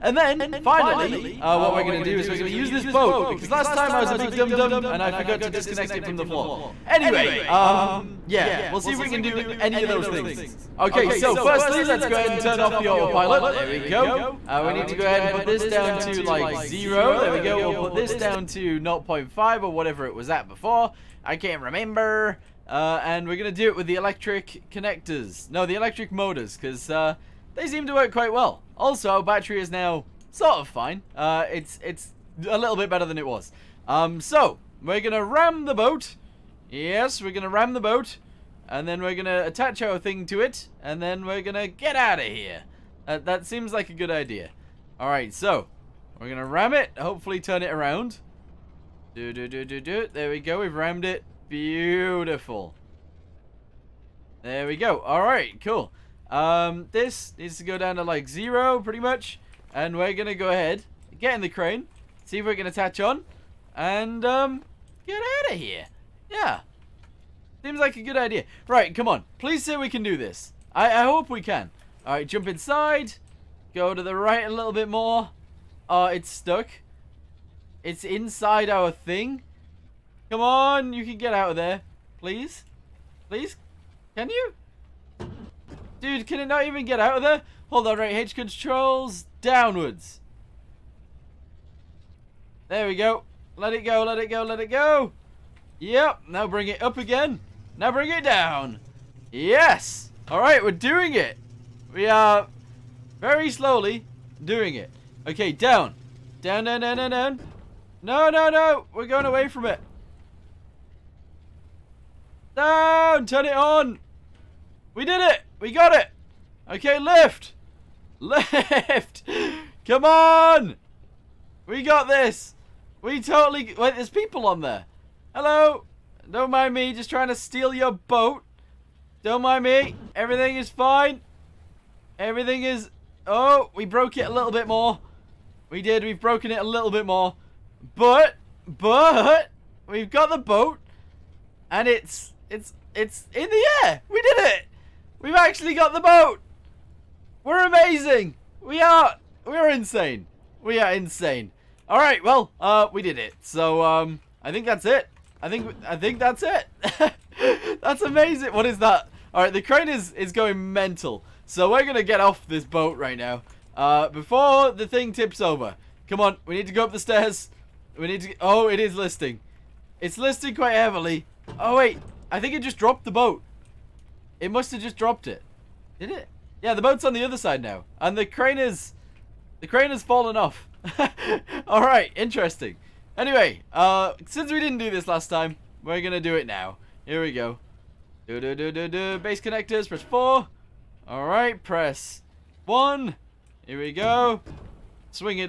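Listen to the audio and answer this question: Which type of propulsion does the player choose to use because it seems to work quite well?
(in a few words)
electric motors.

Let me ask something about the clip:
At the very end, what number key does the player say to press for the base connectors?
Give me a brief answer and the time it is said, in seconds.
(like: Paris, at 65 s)
4, at 189 s.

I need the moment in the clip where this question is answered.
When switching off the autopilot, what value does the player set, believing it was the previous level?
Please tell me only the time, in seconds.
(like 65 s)
18 s.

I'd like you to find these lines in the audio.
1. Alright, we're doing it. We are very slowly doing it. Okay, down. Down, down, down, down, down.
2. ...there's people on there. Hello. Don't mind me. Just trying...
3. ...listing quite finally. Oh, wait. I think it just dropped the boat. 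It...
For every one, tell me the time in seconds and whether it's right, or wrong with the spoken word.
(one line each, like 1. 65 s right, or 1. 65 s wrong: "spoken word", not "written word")
1. 100 s right
2. 123 s right
3. 170 s wrong: "heavily", not "finally".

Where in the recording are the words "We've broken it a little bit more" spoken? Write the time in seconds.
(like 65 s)
136 s.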